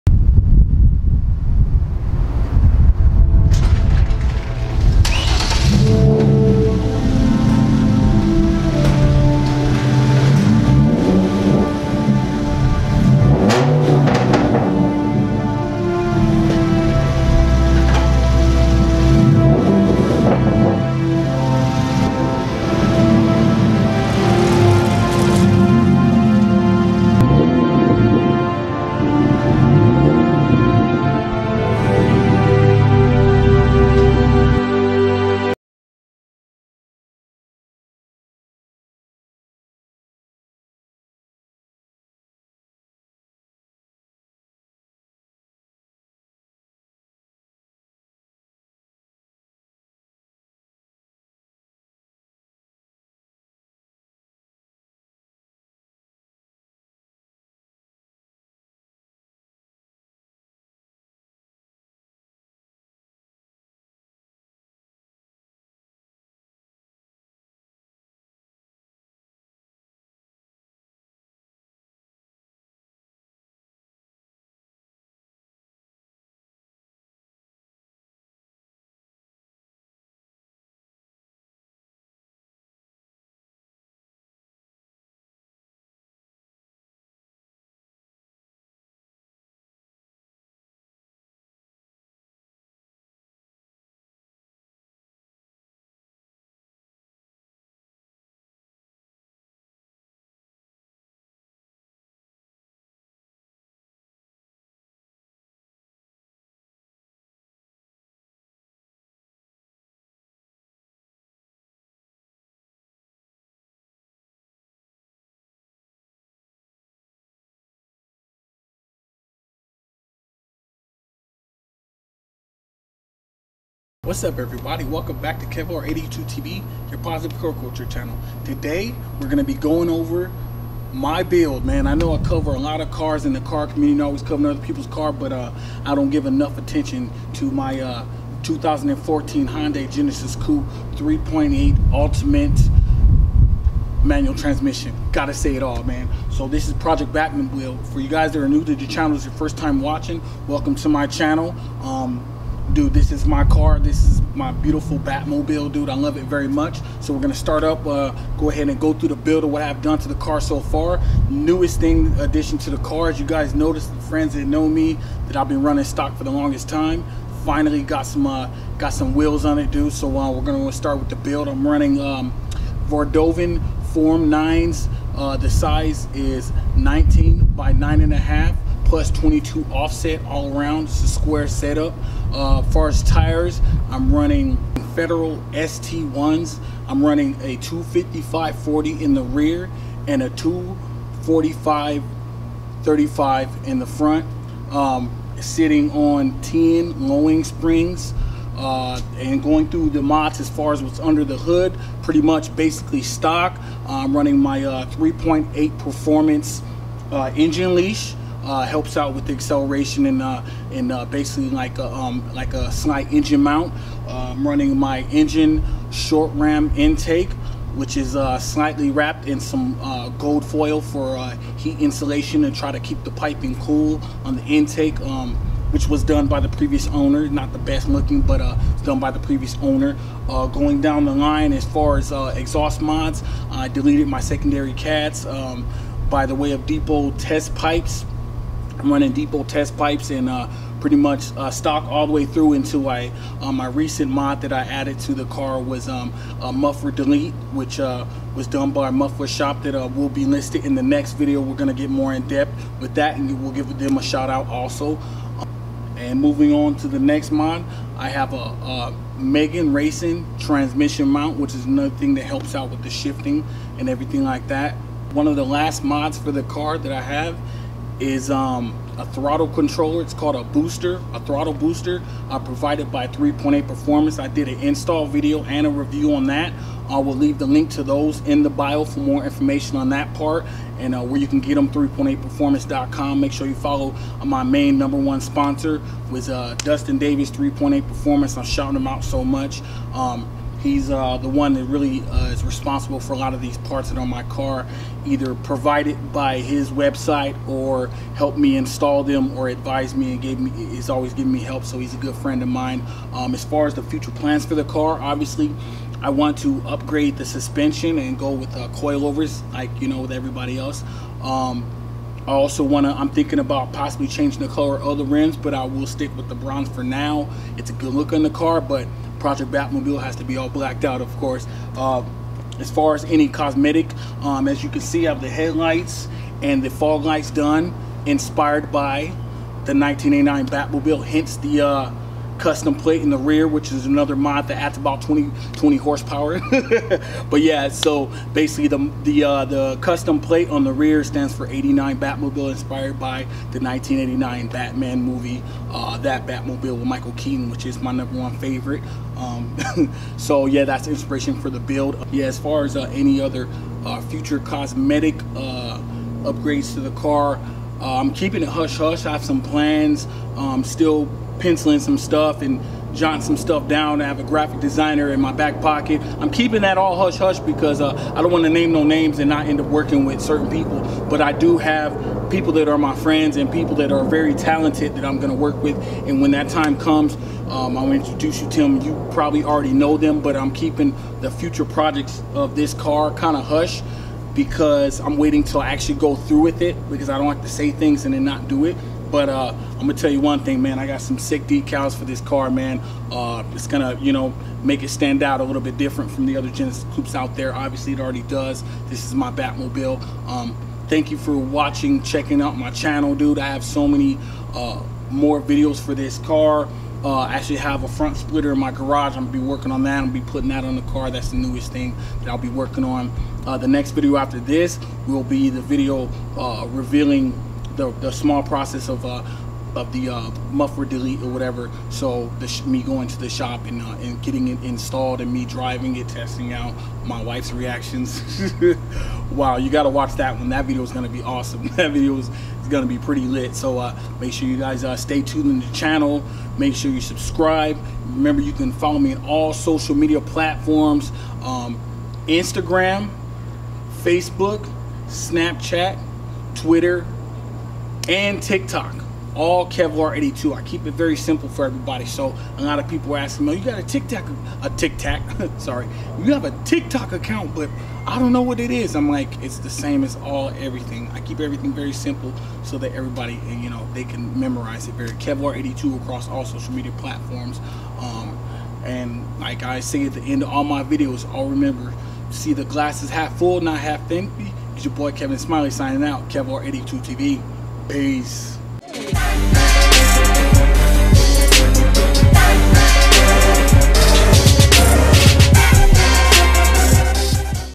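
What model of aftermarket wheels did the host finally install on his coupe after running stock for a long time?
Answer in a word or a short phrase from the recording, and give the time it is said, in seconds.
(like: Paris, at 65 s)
Vordovan Form 9, at 172 s.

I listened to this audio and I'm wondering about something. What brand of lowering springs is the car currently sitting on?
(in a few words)
Tein.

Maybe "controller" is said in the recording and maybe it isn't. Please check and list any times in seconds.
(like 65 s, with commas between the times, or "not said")
269 s.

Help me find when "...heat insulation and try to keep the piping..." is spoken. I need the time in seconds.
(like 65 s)
221 s.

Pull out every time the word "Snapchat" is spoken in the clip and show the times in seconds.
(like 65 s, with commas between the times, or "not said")
445 s.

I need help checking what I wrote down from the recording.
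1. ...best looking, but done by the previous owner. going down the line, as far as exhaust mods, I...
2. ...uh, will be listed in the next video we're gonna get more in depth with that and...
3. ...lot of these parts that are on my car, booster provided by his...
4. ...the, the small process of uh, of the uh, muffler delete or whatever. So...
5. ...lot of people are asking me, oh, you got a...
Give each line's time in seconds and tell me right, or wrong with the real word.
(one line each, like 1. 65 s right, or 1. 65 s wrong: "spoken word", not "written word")
1. 227 s right
2. 249 s right
3. 293 s wrong: "either", not "booster"
4. 417 s right
5. 452 s right.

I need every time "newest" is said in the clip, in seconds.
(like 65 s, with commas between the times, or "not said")
161 s, 411 s.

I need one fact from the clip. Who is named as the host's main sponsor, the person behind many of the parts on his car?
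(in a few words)
Dustin Davies.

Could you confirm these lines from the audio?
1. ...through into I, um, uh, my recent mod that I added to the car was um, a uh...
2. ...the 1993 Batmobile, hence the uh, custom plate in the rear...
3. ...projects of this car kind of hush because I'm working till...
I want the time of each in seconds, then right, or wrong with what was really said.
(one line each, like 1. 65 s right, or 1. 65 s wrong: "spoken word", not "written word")
1. 242 s right
2. 329 s wrong: "1989", not "1993"
3. 381 s wrong: "waiting", not "working".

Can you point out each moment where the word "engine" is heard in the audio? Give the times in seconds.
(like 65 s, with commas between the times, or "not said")
207 s, 213 s.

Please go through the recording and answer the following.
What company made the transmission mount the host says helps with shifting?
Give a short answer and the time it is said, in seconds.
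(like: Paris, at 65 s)
Megan Racing, at 259 s.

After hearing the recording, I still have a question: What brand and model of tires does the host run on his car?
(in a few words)
Federal ST1.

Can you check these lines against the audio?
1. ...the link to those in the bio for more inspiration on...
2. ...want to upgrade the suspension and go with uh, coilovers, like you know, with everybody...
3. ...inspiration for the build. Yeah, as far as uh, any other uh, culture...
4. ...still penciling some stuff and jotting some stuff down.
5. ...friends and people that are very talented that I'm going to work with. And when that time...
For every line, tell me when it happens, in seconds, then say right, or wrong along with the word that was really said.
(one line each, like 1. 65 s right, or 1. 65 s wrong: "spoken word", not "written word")
1. 277 s wrong: "information", not "inspiration"
2. 306 s right
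3. 350 s wrong: "future", not "culture"
4. 360 s right
5. 372 s right.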